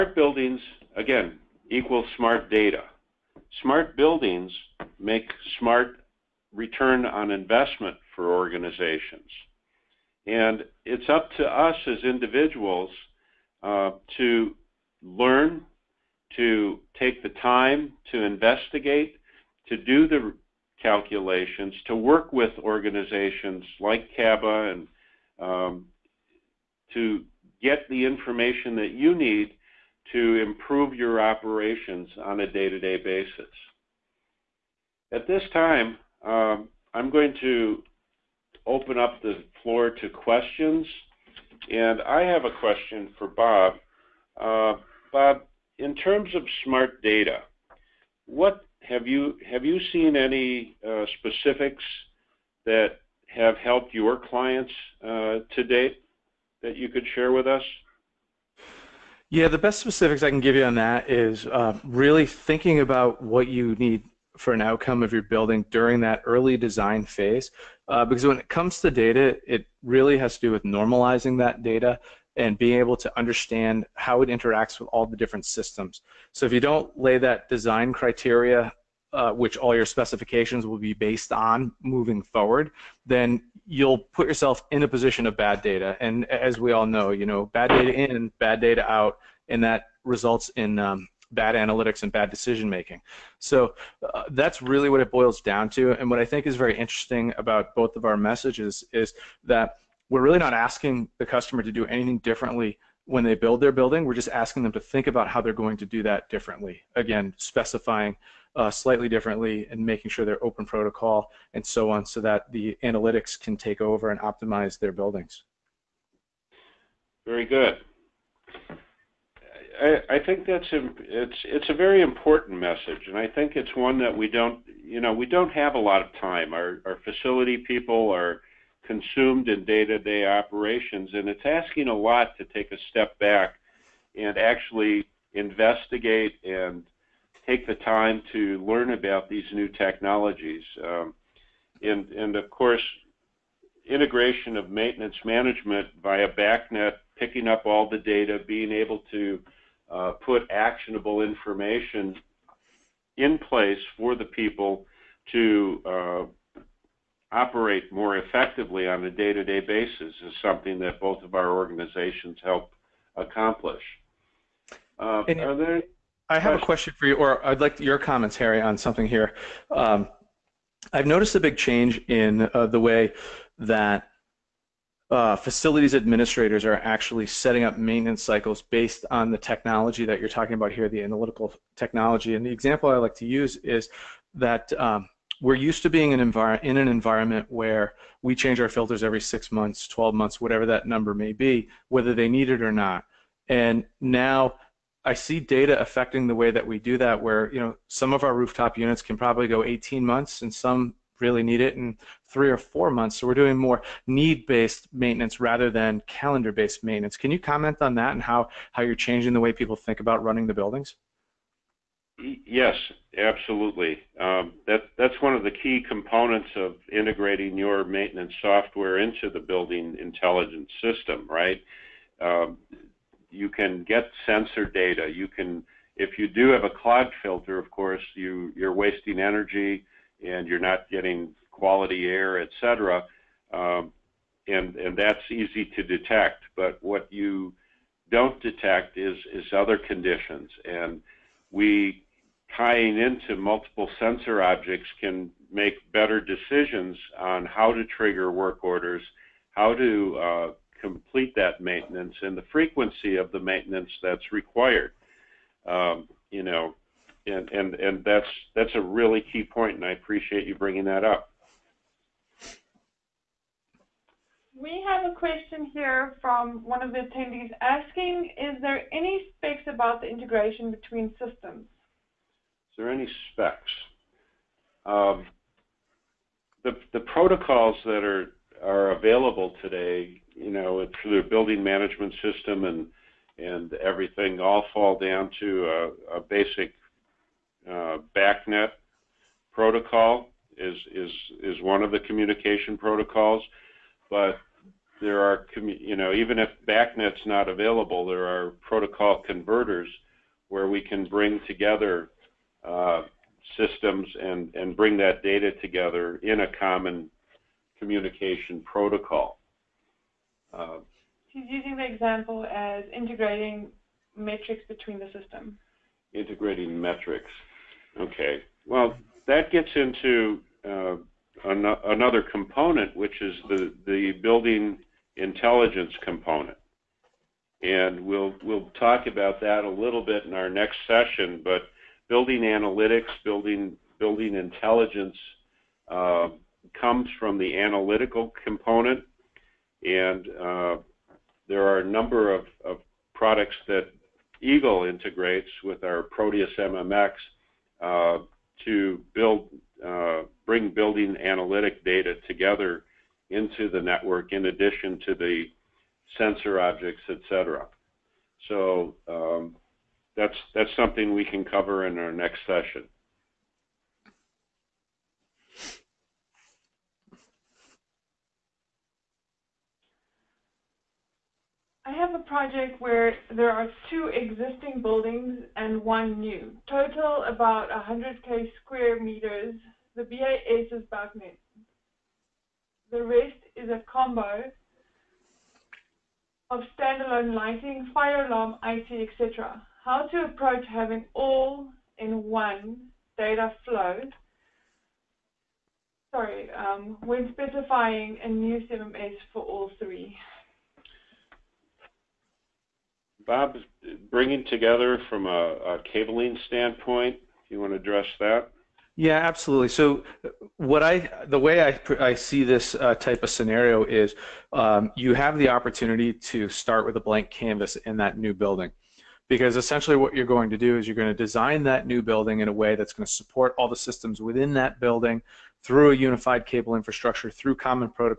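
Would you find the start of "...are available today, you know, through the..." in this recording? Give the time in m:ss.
4:38.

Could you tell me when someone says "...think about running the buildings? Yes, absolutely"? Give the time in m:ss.
3:29.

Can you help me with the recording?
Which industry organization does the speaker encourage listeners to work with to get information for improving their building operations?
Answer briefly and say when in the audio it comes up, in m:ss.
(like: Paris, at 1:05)
CABA, at 0:24.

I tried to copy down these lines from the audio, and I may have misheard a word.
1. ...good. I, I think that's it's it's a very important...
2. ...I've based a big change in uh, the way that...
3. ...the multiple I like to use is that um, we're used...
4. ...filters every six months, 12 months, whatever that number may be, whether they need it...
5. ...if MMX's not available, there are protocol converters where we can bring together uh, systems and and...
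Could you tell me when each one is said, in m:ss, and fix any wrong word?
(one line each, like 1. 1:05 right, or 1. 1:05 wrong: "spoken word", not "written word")
1. 1:57 right
2. 2:50 wrong: "noticed", not "based"
3. 3:02 wrong: "example", not "multiple"
4. 3:08 right
5. 4:56 wrong: "BACnet", not "MMX".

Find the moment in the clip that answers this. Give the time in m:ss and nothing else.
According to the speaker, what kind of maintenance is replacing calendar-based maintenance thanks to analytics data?
3:24.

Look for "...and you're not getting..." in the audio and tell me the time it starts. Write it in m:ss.
3:50.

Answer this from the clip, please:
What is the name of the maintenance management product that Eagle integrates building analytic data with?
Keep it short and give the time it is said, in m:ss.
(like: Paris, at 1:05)
Proteus MMX, at 5:46.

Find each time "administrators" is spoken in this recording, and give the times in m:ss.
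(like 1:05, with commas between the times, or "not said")
2:55.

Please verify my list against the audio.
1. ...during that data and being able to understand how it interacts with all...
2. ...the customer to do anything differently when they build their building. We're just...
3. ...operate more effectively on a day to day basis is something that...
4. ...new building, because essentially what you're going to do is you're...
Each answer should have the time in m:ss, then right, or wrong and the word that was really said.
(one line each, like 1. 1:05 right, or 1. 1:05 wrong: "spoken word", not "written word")
1. 1:10 wrong: "normalizing", not "during"
2. 1:41 right
3. 2:37 right
4. 6:58 right.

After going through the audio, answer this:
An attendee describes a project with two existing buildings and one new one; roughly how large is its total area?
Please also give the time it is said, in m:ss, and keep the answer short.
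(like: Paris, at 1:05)
100k square meters, at 6:17.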